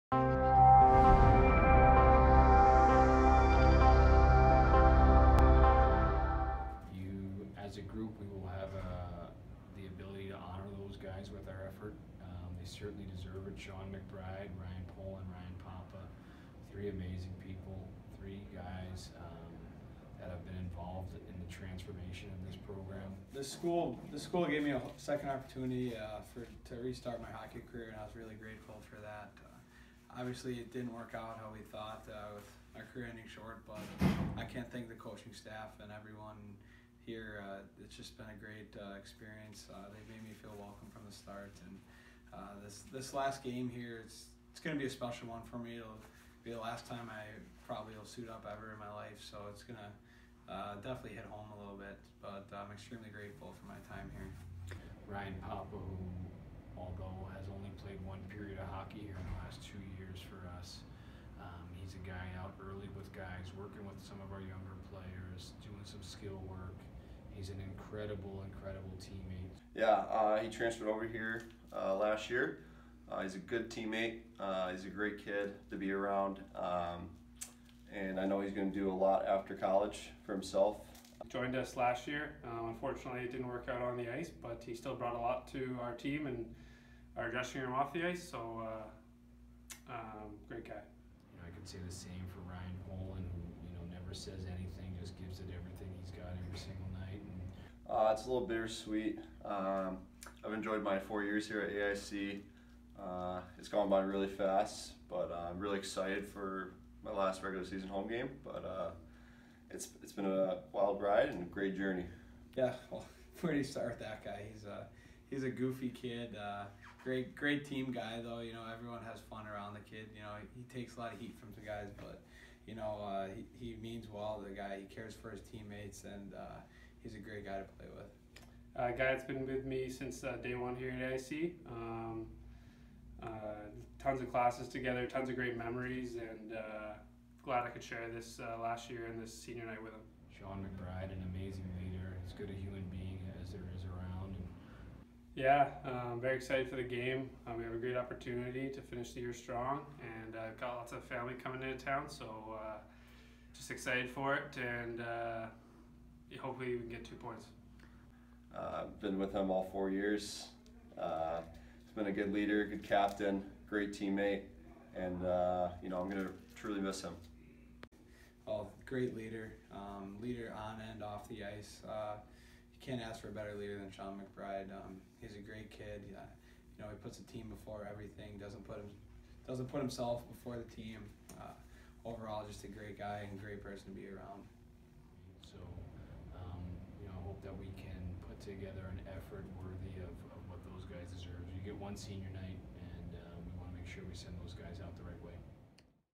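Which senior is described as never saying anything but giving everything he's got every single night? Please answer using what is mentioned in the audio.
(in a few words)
Ryan Polin.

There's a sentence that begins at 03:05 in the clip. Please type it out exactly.
So, um, you know, I hope that we can put together an effort worthy of, of what those guys deserve.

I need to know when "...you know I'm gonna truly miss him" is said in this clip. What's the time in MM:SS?
02:45.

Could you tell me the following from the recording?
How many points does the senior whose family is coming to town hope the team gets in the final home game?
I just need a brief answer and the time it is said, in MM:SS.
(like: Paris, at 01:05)
2, at 02:37.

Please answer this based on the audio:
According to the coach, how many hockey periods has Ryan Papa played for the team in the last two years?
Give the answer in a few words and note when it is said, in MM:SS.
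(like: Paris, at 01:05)
1, at 00:58.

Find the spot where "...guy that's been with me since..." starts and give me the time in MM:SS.
02:08.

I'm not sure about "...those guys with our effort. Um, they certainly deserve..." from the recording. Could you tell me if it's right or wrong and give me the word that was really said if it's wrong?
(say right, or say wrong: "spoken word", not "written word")
right.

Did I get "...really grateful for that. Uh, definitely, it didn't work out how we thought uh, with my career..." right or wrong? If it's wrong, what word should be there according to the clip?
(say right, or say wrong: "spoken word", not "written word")
wrong: "obviously", not "definitely".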